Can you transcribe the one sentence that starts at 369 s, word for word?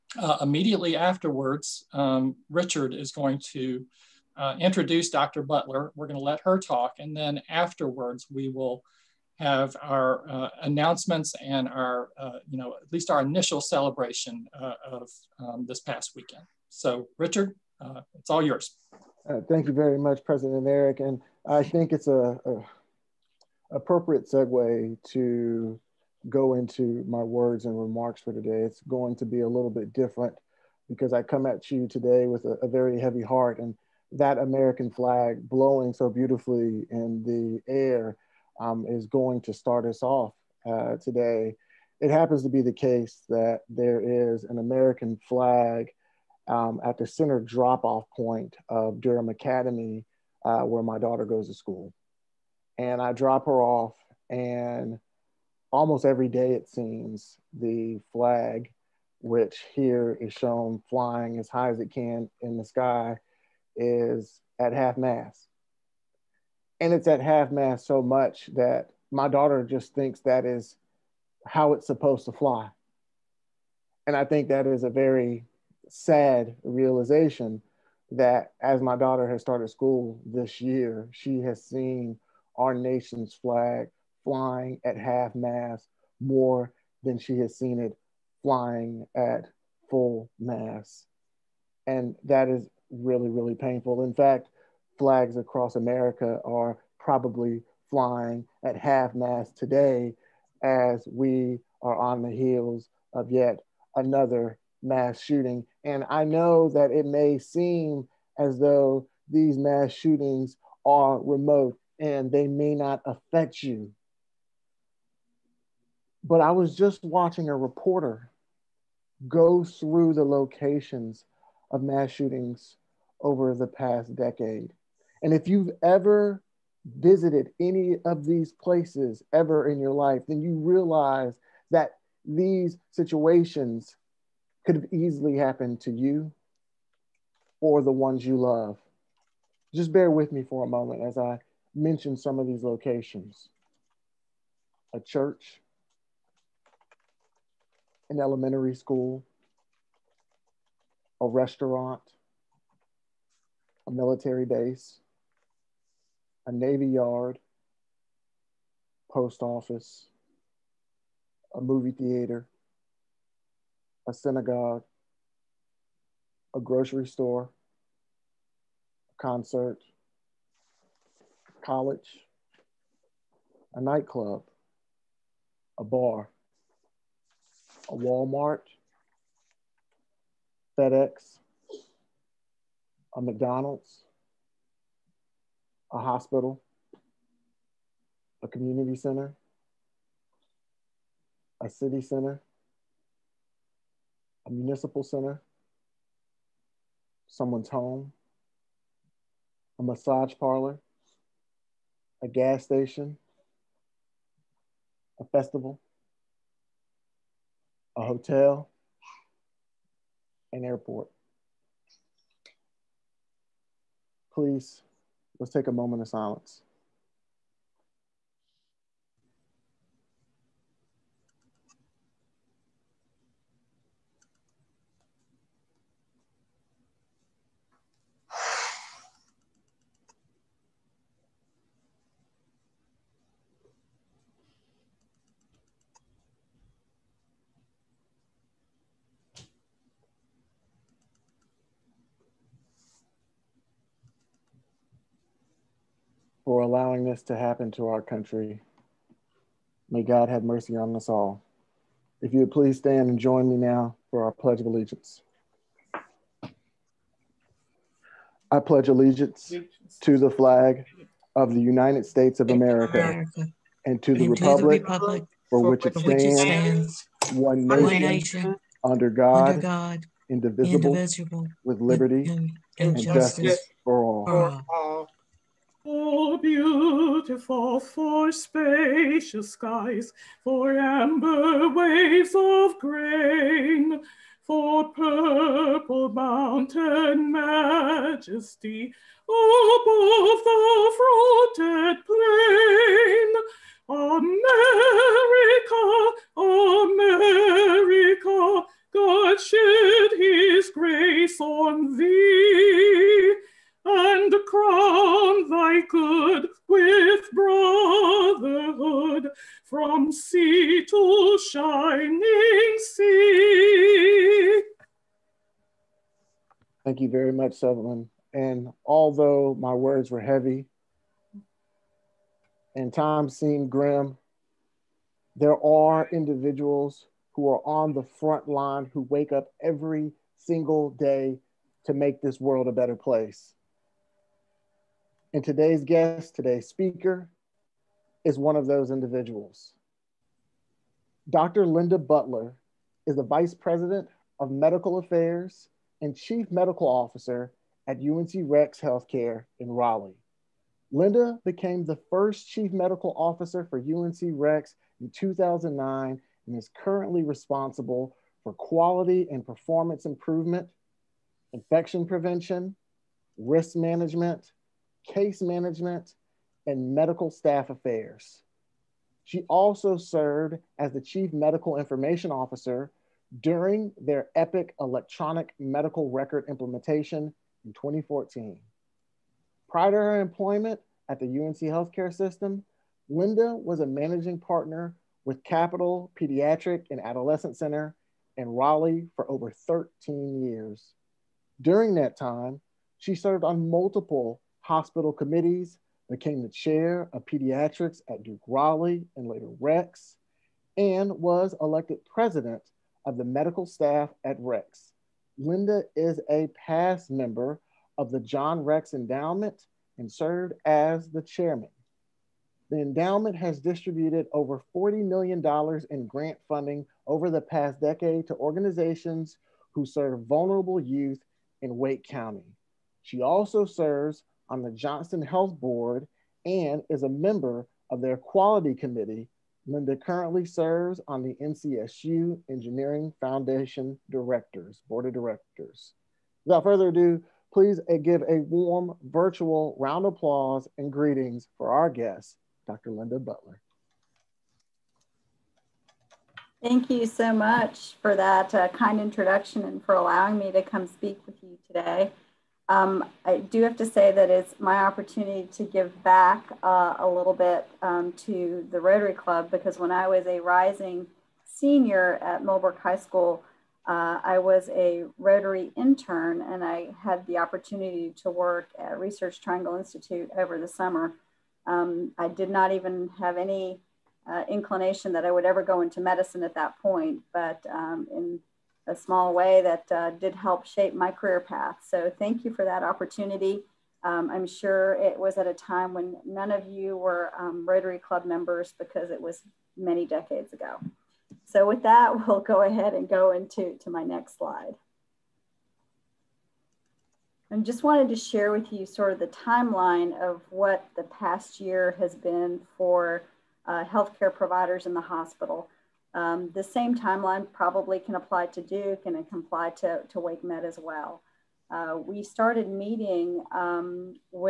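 She also served as the chief medical information officer during their EPIC electronic medical record implementation in 2014.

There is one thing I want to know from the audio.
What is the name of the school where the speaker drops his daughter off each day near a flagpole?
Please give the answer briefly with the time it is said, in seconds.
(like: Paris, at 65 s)
Durham Academy, at 49 s.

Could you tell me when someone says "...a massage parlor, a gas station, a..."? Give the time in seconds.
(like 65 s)
199 s.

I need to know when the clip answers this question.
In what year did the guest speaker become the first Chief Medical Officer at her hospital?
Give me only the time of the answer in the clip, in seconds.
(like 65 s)
355 s.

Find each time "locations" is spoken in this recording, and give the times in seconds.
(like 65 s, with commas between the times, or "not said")
120 s, 142 s.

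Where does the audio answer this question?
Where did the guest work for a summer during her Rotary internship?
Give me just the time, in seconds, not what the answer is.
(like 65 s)
468 s.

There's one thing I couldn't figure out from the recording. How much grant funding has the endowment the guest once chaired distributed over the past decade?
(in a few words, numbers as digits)
$40 million.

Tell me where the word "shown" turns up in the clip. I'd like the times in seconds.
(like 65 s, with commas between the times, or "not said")
60 s.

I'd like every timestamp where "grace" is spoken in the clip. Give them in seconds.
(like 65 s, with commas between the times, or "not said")
300 s.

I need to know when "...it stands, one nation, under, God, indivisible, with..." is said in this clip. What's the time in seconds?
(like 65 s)
265 s.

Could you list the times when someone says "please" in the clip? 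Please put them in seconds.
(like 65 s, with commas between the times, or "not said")
214 s, 252 s, 437 s.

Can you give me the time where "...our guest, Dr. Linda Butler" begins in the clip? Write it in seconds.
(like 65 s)
441 s.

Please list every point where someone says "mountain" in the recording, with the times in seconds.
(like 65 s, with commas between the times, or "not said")
286 s.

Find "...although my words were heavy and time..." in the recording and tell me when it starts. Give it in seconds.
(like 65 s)
318 s.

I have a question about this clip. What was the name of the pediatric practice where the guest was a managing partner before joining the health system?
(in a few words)
Capital Pediatric and Adolescent Center.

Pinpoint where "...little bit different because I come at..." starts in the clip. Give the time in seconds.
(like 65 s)
29 s.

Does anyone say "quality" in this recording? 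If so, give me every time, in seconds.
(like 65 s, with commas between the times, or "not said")
358 s, 428 s.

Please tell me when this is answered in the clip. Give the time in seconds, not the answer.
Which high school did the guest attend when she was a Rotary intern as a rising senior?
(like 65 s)
462 s.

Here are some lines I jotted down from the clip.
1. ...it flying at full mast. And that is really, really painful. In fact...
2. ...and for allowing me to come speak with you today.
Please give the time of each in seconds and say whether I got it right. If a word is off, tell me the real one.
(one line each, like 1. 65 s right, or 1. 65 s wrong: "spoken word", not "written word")
1. 87 s right
2. 449 s right.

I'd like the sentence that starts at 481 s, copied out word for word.
So thank you for that opportunity.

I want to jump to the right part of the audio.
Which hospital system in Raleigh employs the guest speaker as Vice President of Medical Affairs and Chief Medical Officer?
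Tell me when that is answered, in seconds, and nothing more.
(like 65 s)
347 s.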